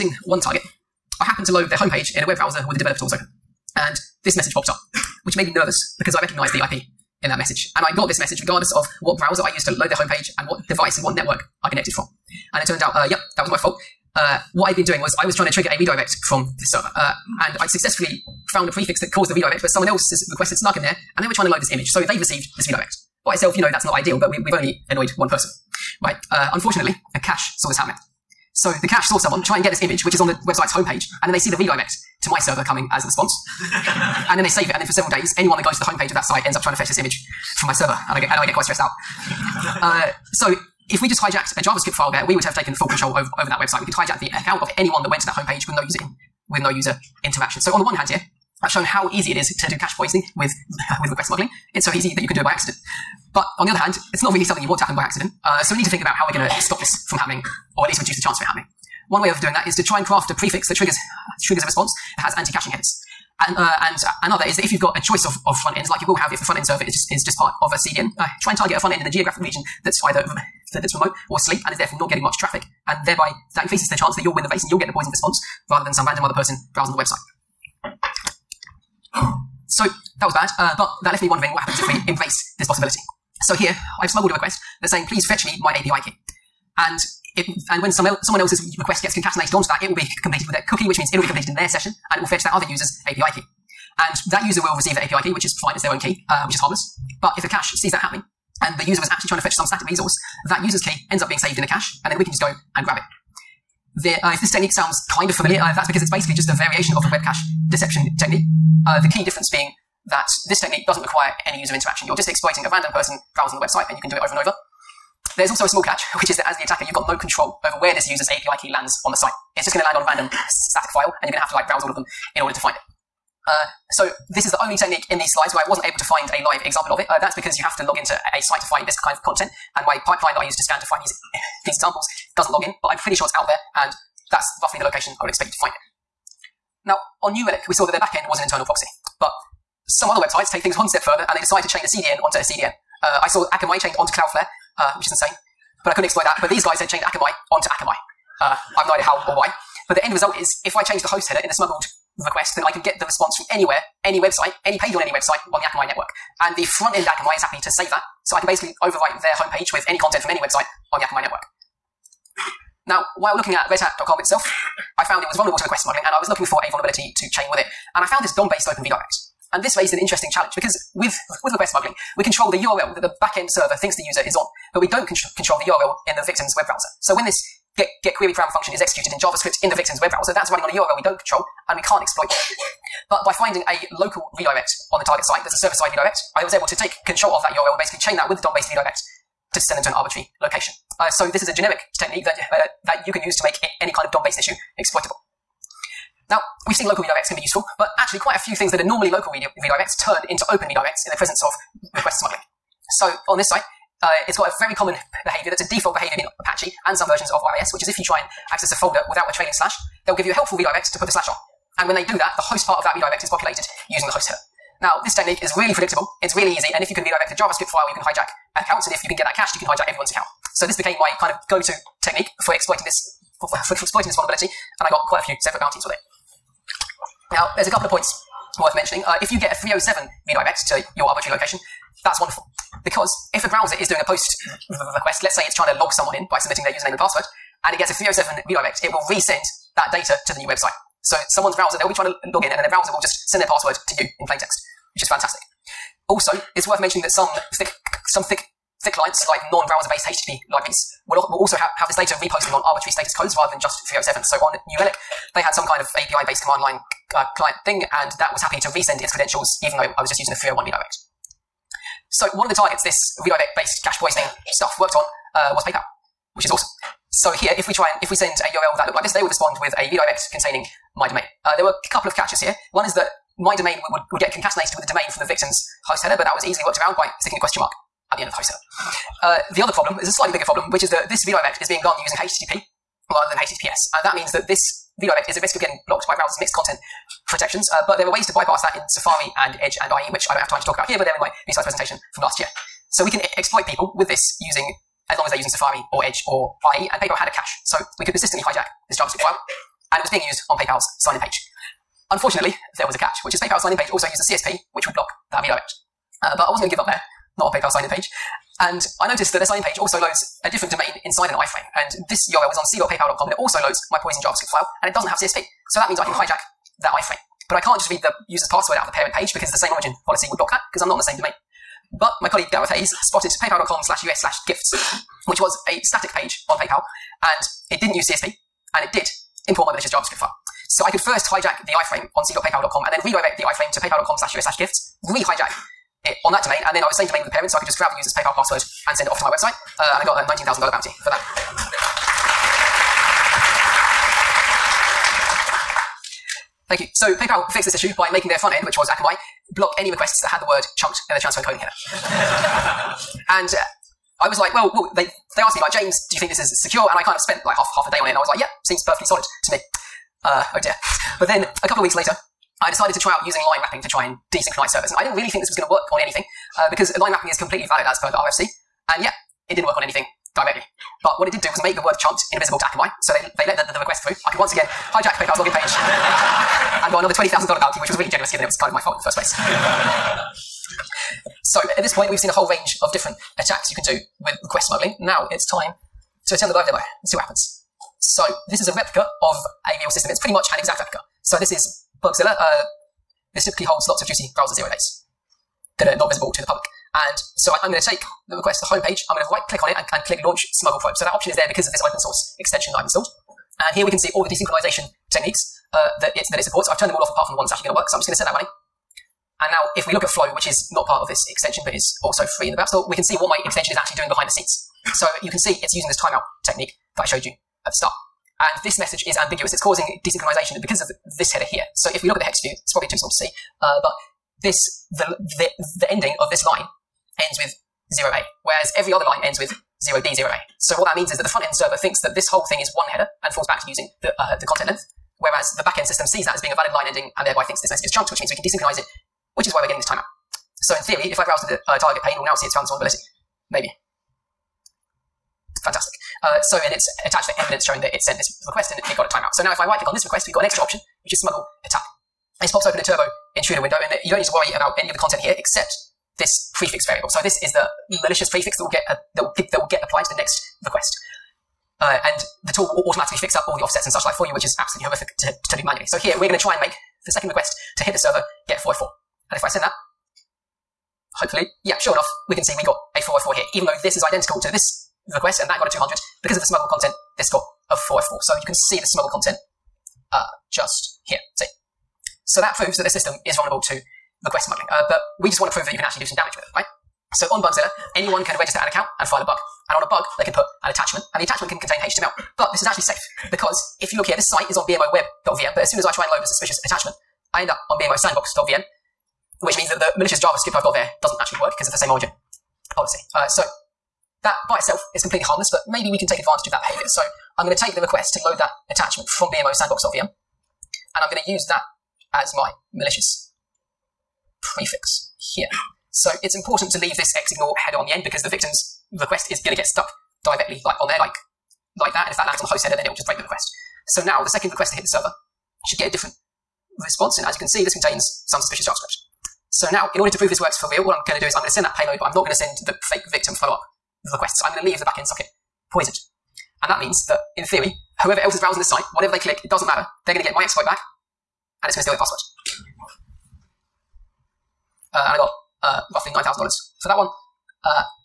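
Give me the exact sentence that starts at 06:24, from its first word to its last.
Now it's time to attend the live demo and see what happens.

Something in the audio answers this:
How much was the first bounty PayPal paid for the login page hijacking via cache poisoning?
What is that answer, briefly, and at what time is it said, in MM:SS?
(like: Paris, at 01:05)
$19,000, at 05:40.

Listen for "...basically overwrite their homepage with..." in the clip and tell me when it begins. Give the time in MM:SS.
02:38.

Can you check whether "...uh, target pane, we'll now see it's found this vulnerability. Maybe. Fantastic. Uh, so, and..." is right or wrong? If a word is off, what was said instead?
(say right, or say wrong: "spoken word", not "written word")
right.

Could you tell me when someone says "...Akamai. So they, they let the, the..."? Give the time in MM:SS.
06:12.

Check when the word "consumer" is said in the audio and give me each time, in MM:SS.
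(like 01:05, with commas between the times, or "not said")
not said.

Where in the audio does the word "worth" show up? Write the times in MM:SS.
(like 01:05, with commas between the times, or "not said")
03:48, 04:06.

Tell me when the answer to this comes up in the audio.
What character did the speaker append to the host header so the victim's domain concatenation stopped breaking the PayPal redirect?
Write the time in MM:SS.
04:37.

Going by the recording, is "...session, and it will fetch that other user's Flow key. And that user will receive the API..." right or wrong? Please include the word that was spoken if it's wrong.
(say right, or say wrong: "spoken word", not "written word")
wrong: "API", not "Flow".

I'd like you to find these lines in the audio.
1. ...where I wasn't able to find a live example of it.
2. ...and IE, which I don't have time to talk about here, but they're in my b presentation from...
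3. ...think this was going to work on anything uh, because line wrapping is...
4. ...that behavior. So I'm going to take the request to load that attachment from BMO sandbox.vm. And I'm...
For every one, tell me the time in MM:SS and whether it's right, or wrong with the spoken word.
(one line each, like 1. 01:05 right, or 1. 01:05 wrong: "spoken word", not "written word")
1. 02:05 right
2. 04:49 right
3. 06:05 right
4. 08:26 right.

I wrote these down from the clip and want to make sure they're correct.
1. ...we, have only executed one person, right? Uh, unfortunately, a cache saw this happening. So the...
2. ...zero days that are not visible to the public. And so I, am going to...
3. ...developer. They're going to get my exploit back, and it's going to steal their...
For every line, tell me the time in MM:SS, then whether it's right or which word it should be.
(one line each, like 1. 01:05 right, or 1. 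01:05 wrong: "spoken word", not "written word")
1. 00:24 wrong: "annoyed", not "executed"
2. 06:34 right
3. 08:59 wrong: "matter", not "developer".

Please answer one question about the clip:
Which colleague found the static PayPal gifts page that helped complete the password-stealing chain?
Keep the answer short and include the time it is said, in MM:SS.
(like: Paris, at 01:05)
Gareth Hayes, at 05:22.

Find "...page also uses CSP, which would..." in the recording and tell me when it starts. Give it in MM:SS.
05:03.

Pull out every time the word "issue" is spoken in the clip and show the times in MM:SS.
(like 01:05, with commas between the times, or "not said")
03:14, 05:47.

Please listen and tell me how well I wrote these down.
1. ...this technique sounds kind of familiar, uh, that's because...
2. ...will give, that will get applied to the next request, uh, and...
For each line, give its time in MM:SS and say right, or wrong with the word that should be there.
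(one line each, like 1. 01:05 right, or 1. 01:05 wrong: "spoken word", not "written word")
1. 01:44 right
2. 07:39 right.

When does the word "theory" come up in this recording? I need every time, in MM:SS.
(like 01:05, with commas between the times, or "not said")
07:20, 08:57.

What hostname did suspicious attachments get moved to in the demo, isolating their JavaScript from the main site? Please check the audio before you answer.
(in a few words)
bmosandbox.vm.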